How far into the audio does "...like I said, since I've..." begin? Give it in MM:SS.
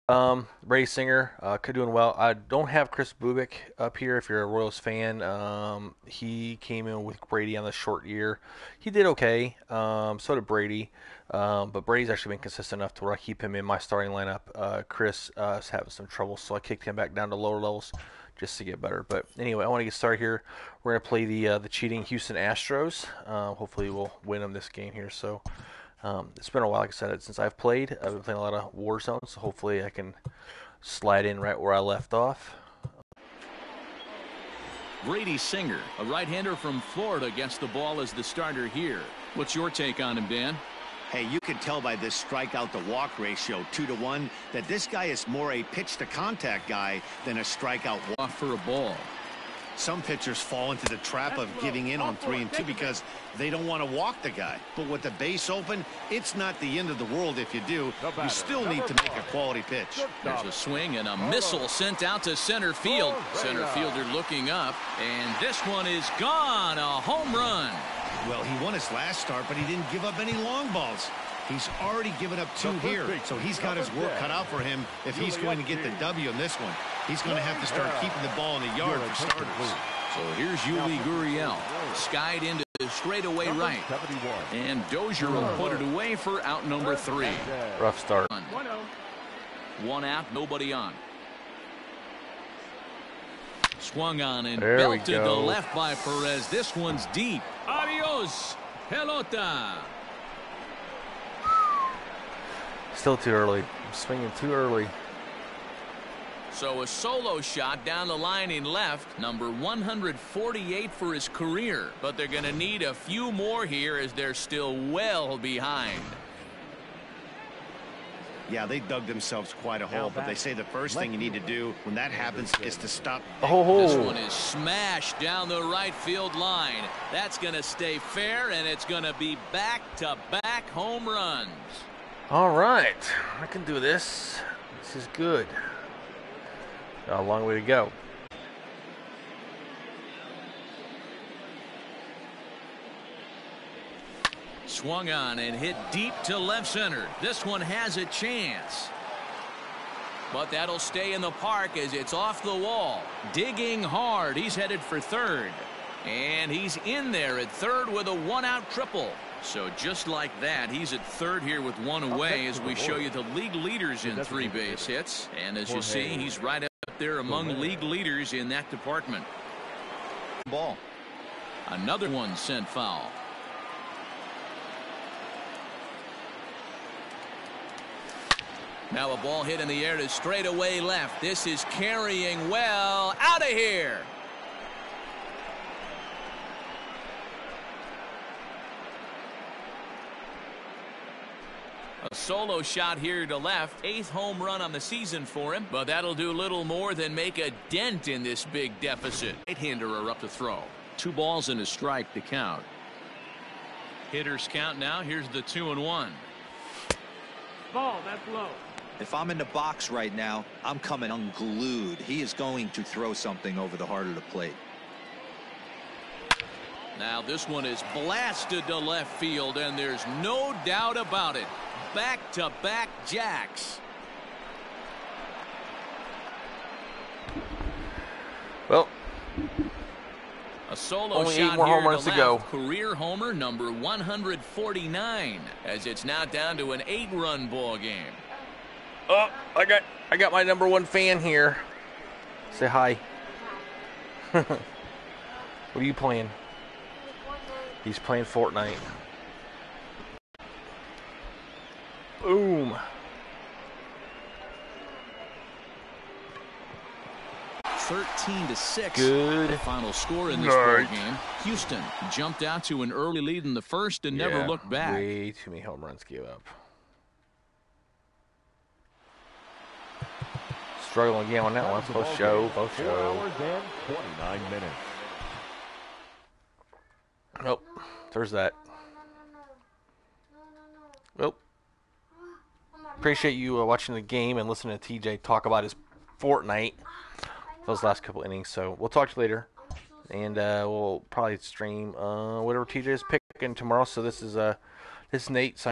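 00:26.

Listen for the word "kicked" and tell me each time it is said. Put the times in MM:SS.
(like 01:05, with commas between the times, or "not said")
00:16.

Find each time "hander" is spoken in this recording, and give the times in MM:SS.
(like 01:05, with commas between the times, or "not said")
00:36, 03:19.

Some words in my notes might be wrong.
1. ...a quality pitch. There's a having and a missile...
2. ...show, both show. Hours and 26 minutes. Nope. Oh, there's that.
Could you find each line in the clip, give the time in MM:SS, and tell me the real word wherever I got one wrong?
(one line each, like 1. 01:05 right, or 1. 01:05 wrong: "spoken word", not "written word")
1. 00:59 wrong: "swing", not "having"
2. 04:32 wrong: "29", not "26".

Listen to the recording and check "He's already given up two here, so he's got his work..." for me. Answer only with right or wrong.
right.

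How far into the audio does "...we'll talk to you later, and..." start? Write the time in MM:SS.
04:48.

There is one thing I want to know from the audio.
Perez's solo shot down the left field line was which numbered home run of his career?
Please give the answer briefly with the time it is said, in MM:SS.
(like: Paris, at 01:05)
148, at 01:49.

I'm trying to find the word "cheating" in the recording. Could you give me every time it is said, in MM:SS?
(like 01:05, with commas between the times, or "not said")
00:21.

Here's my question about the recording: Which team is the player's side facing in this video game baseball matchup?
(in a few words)
Houston Astros.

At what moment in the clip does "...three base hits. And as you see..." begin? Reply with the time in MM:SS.
02:44.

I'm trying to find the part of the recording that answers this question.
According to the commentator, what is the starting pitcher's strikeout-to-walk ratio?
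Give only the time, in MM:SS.
00:43.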